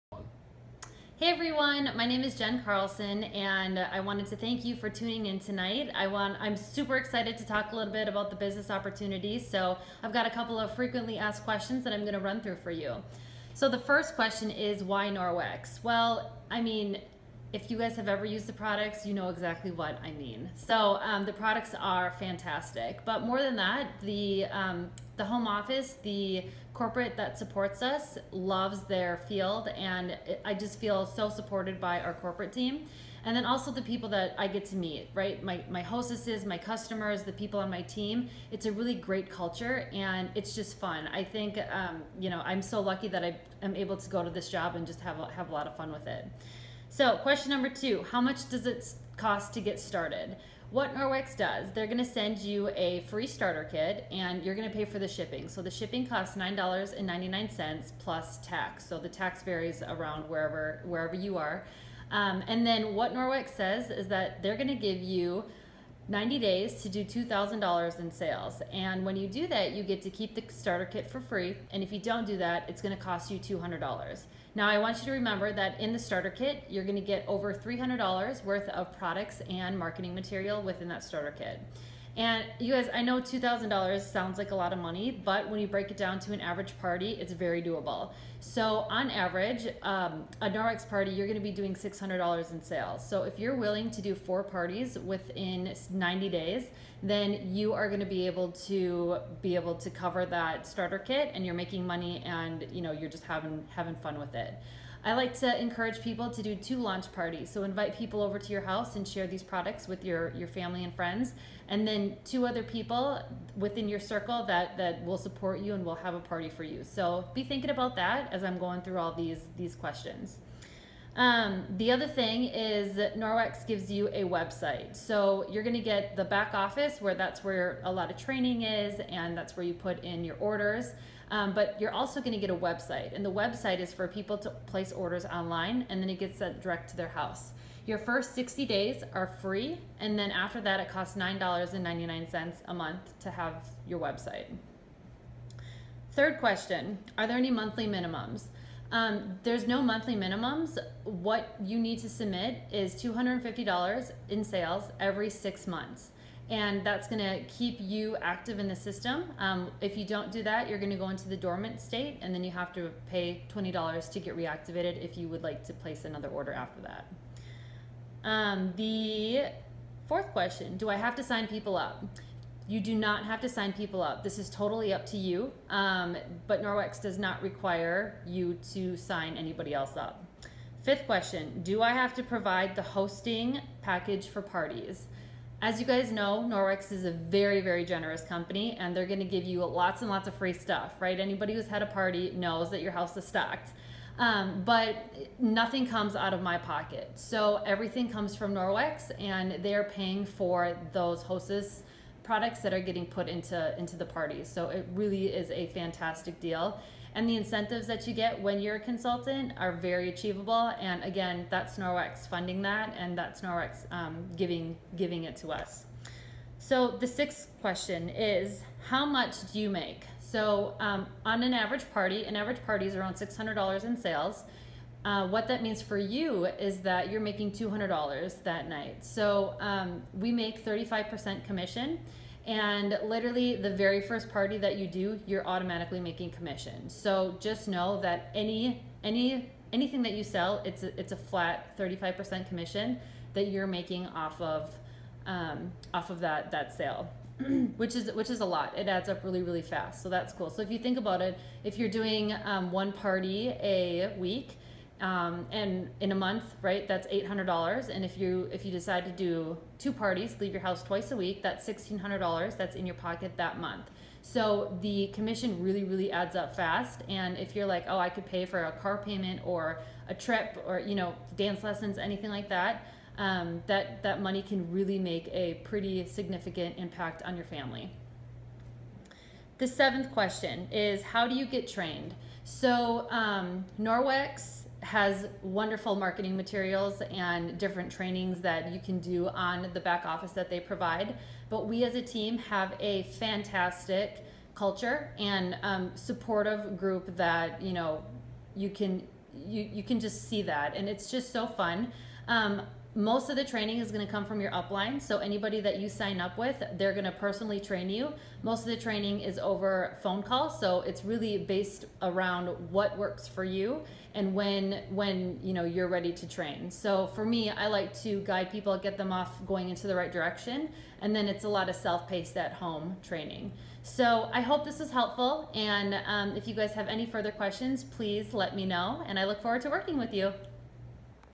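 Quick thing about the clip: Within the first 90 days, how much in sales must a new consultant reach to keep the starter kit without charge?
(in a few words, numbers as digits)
$2,000.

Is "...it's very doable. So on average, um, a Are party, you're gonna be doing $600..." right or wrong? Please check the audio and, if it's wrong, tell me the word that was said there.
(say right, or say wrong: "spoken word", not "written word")
wrong: "Norwex", not "Are".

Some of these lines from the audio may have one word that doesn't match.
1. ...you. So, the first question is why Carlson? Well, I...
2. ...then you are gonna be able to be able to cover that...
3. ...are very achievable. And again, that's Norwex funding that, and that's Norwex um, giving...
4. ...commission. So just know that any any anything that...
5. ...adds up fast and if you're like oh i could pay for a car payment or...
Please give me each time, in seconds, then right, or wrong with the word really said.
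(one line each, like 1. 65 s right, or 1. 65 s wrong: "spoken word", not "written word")
1. 12 s wrong: "Norwex", not "Carlson"
2. 97 s right
3. 209 s right
4. 236 s right
5. 266 s right.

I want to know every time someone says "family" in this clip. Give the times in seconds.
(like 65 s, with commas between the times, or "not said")
110 s, 277 s.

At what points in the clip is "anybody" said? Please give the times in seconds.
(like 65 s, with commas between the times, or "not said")
179 s, 191 s, 305 s.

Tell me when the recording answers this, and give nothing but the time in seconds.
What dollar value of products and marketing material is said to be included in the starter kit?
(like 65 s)
77 s.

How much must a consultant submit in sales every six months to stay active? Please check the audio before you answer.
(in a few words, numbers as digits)
$250.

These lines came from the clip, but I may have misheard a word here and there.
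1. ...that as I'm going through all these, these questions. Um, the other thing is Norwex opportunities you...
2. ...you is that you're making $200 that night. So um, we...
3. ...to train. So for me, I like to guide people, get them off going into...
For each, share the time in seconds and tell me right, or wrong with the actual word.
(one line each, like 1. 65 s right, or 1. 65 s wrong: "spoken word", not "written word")
1. 117 s wrong: "gives", not "opportunities"
2. 225 s right
3. 316 s right.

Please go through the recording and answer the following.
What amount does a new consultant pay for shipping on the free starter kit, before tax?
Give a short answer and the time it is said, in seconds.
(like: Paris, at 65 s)
$9.99, at 56 s.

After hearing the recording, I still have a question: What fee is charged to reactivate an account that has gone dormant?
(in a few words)
$20.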